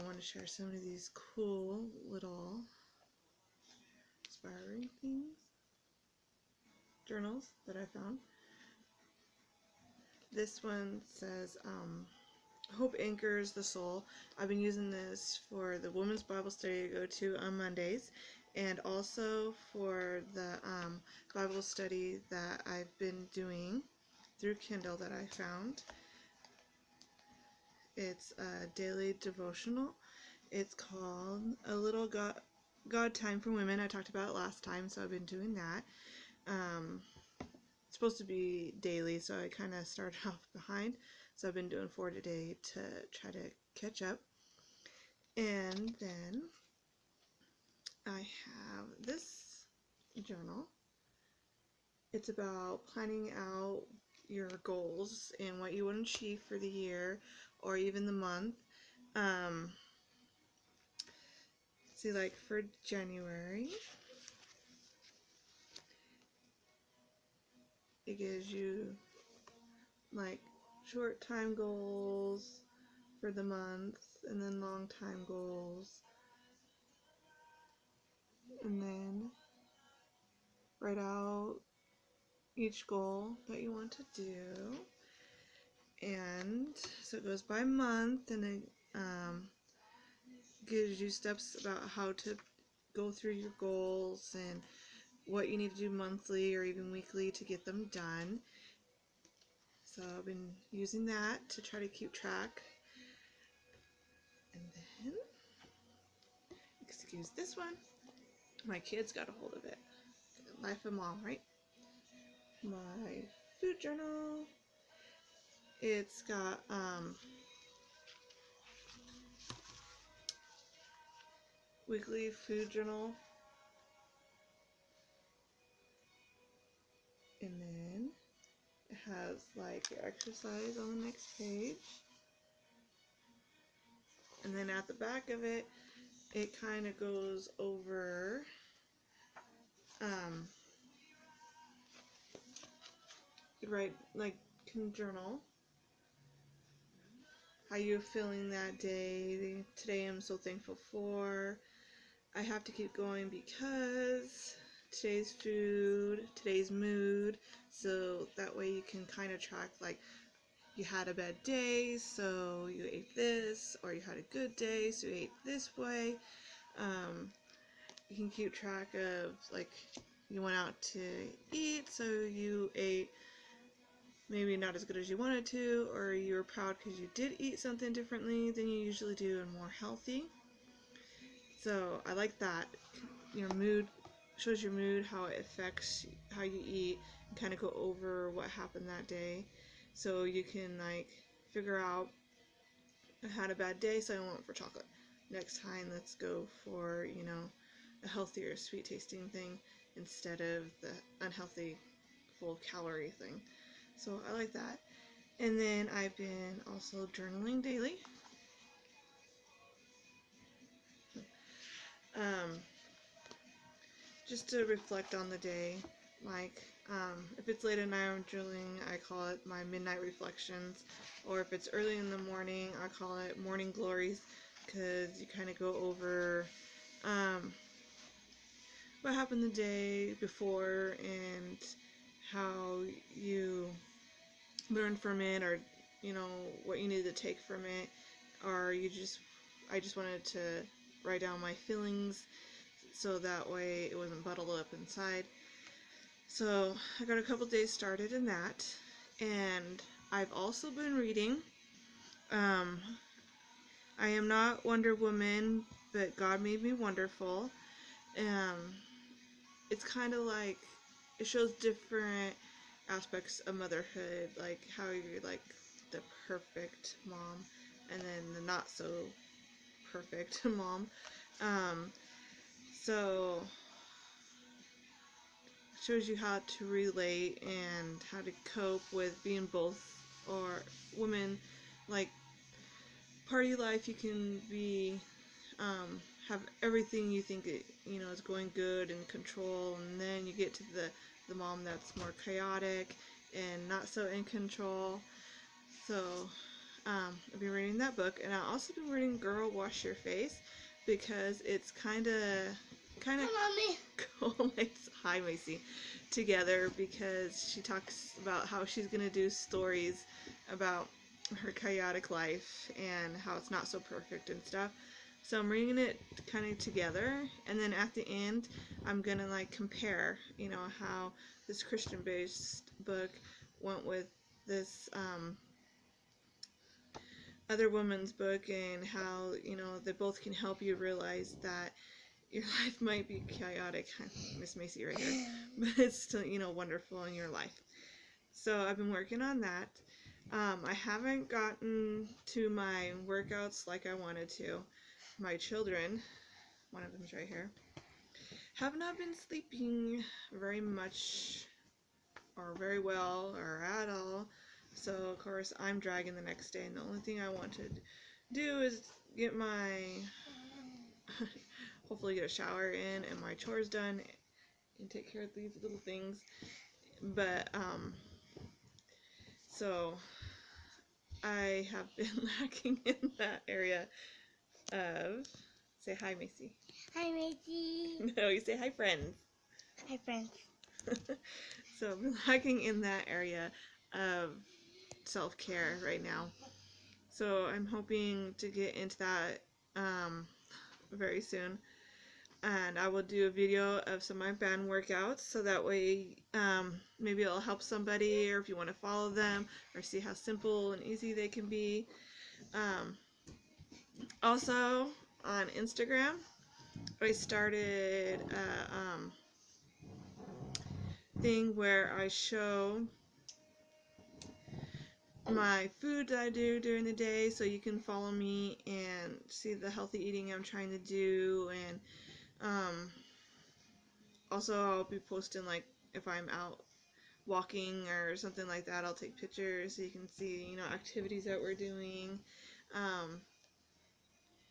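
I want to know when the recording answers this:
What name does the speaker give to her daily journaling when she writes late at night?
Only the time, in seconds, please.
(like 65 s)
219 s.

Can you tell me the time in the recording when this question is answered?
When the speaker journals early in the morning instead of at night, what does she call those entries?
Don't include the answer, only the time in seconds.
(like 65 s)
223 s.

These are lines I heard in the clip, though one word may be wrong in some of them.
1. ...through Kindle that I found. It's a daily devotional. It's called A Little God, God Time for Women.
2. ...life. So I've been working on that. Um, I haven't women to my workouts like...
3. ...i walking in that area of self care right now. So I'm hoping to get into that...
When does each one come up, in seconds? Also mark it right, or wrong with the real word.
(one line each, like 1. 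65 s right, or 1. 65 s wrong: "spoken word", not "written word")
1. 24 s right
2. 337 s wrong: "gotten", not "women"
3. 382 s wrong: "lacking", not "walking".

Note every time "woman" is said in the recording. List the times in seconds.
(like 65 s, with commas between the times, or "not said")
254 s, 327 s.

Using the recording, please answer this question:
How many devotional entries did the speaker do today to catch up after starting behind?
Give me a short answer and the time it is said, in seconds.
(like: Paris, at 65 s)
4, at 41 s.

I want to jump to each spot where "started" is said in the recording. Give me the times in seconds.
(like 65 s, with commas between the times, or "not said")
39 s, 247 s, 407 s.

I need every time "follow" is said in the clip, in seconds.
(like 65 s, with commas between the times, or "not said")
398 s, 417 s.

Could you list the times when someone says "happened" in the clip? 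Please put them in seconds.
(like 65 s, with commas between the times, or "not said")
188 s, 229 s.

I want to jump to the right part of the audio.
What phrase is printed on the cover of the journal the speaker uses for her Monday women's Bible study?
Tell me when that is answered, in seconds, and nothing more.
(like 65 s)
12 s.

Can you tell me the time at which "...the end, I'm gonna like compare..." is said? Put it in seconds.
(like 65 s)
317 s.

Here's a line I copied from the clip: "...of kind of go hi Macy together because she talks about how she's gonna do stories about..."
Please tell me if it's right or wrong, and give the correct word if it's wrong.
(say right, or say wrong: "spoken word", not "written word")
right.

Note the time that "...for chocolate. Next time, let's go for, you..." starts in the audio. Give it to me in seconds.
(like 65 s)
194 s.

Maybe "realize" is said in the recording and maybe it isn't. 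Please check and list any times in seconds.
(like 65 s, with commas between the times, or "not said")
330 s.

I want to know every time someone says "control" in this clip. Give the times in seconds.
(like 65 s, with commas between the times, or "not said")
289 s, 294 s.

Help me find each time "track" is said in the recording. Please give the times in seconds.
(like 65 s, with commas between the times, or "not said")
102 s, 159 s, 168 s.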